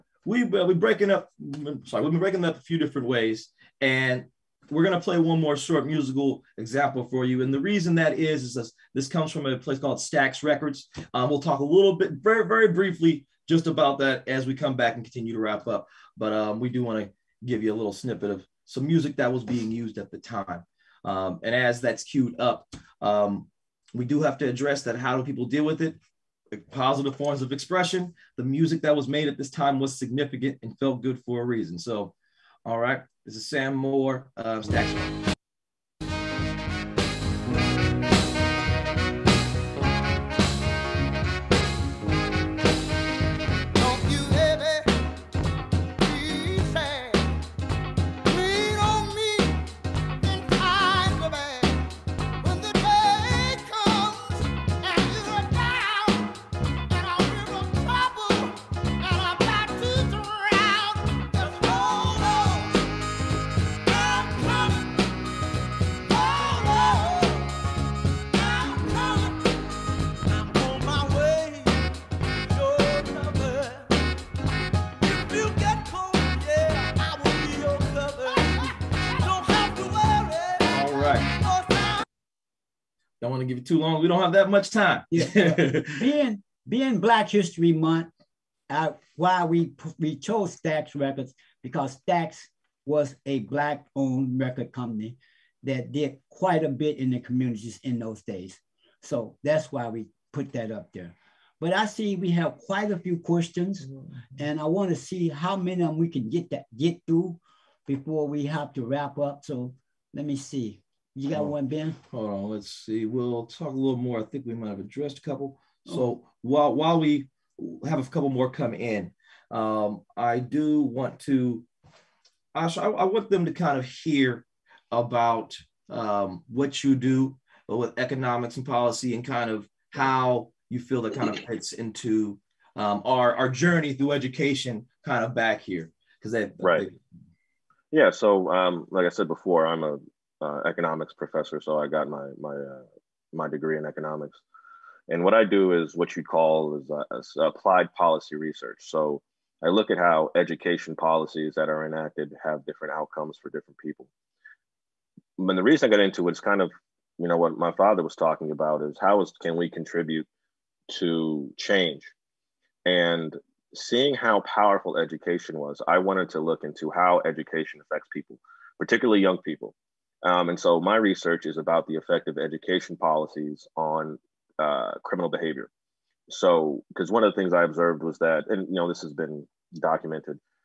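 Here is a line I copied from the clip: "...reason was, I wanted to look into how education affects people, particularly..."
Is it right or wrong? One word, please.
wrong.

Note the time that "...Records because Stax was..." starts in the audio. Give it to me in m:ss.
1:30.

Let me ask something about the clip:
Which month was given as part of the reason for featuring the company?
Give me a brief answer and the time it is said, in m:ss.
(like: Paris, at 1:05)
Black History Month, at 1:26.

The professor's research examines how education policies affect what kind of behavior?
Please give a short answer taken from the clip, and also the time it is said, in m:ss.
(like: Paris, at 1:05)
criminal behavior, at 2:55.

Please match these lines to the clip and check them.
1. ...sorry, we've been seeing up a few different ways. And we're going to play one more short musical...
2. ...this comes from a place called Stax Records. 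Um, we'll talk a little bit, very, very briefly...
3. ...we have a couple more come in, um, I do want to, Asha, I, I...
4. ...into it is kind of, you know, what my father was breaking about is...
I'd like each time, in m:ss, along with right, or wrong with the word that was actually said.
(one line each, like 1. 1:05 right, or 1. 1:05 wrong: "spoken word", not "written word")
1. 0:01 wrong: "breaking", not "seeing"
2. 0:08 right
3. 1:56 right
4. 2:36 wrong: "talking", not "breaking".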